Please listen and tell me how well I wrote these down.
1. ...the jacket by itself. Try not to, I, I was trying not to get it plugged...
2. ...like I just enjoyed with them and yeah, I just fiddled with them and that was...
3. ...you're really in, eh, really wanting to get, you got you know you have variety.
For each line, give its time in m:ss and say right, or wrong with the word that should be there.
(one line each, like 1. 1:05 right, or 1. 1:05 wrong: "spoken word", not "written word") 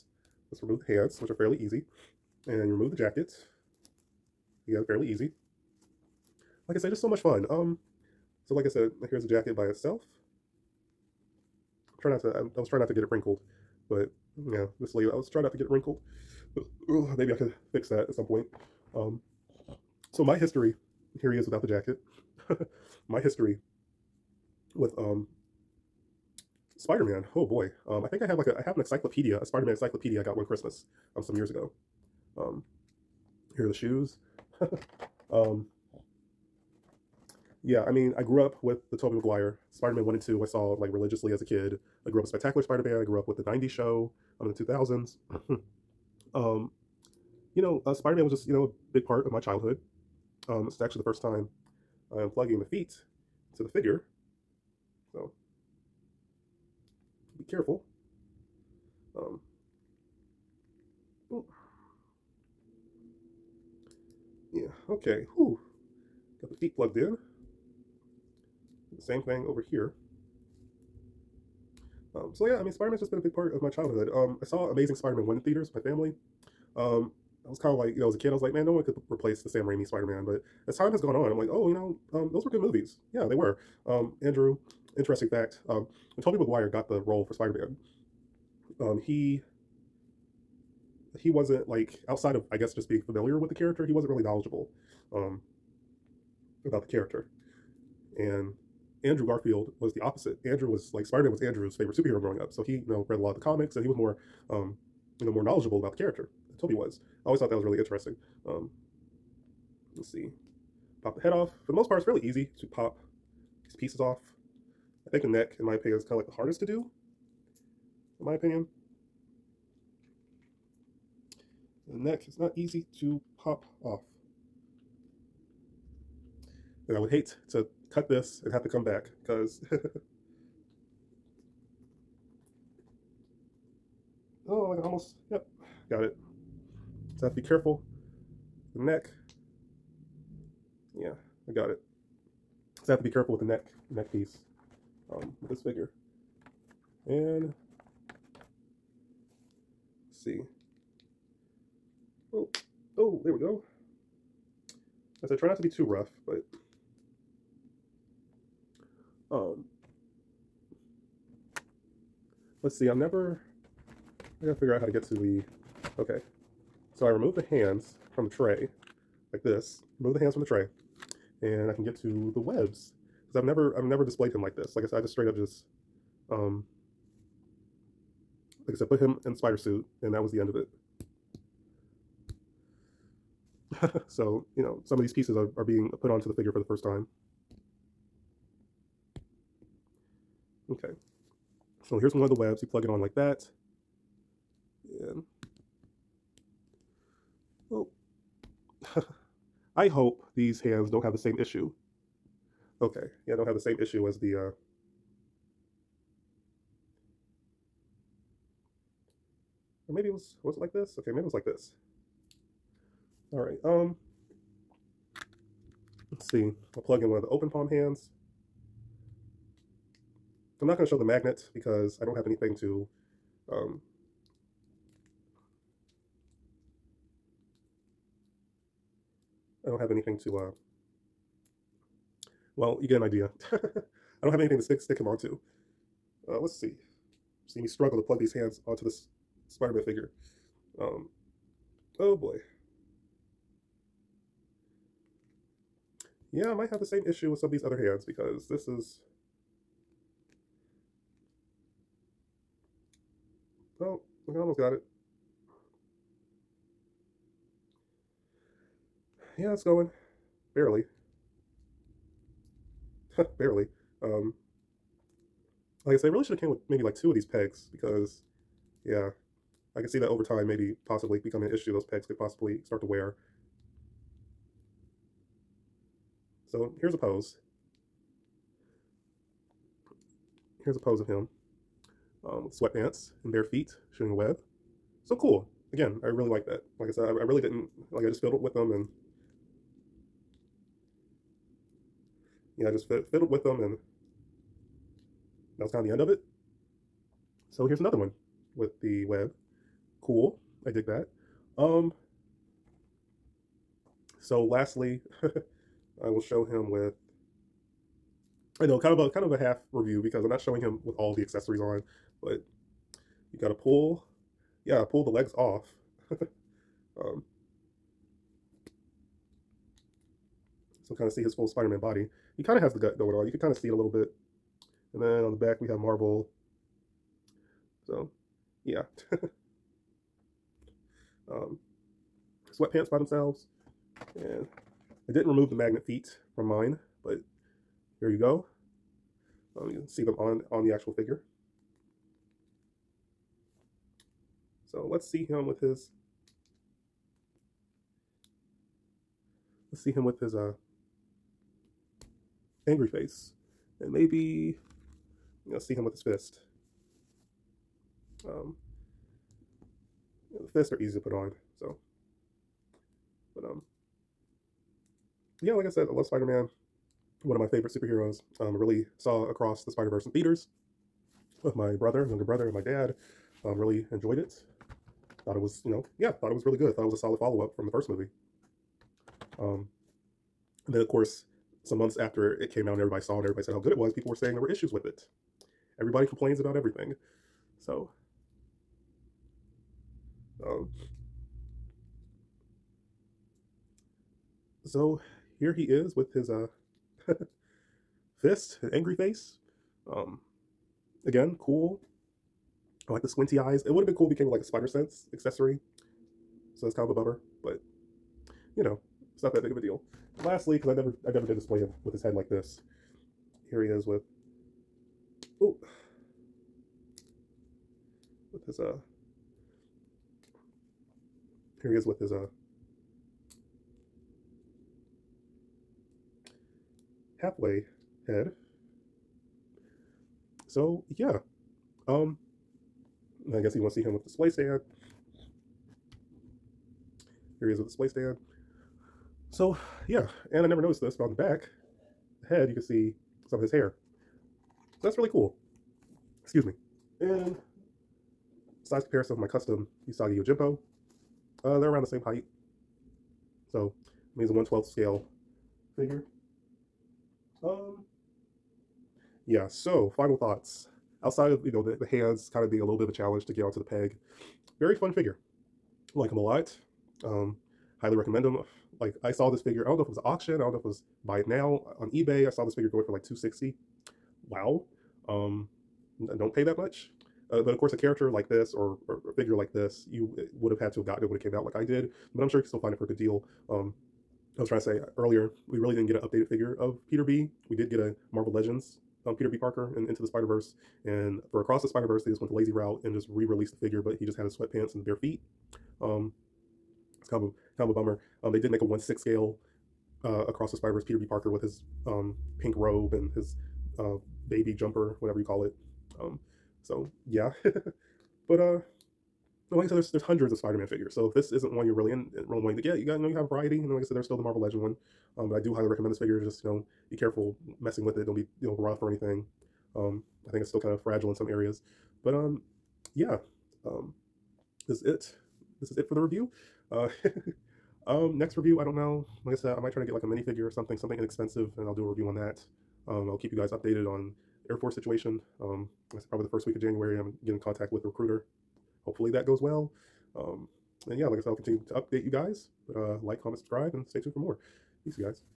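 1. 0:09 wrong: "wrinkled", not "plugged"
2. 4:47 wrong: "fiddled", not "enjoyed"
3. 8:31 right.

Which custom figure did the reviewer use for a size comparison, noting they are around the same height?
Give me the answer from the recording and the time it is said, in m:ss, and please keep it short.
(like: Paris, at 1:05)
Usagi Yojimbo, at 7:29.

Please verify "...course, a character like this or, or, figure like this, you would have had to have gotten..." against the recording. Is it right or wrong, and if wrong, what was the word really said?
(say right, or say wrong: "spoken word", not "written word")
right.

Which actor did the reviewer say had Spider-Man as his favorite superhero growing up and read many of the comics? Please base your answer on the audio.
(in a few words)
Andrew Garfield.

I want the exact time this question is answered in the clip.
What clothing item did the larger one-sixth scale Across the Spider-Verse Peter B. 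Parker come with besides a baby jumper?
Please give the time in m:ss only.
8:22.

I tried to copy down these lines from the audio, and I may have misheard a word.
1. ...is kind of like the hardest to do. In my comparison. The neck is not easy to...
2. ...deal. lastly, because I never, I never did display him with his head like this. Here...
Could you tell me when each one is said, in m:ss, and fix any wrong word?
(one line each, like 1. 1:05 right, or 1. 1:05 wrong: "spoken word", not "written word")
1. 1:55 wrong: "opinion", not "comparison"
2. 6:49 right.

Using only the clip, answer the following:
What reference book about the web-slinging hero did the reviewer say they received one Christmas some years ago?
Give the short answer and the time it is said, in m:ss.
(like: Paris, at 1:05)
Spider-Man encyclopedia, at 0:29.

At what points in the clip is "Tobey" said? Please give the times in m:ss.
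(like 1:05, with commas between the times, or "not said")
0:38, 1:26, 1:46.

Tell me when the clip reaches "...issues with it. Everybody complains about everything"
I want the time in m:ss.
6:24.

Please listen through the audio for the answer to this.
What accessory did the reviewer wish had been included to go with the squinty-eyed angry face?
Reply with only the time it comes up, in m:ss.
6:44.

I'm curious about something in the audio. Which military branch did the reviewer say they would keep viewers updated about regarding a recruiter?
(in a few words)
Air Force.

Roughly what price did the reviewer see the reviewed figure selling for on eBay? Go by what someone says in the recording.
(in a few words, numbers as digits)
260.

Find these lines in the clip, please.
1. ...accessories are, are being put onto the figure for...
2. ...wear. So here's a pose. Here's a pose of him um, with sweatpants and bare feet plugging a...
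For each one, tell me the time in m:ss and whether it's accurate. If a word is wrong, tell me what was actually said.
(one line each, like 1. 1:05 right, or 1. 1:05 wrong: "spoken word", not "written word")
1. 3:05 wrong: "pieces", not "accessories"
2. 4:32 wrong: "shooting", not "plugging".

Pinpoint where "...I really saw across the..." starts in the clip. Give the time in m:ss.
6:08.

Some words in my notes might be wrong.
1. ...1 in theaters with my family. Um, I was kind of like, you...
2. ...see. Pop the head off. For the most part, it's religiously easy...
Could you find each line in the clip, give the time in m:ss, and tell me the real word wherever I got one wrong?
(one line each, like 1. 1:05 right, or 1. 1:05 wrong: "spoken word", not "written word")
1. 1:15 right
2. 1:50 wrong: "fairly", not "religiously".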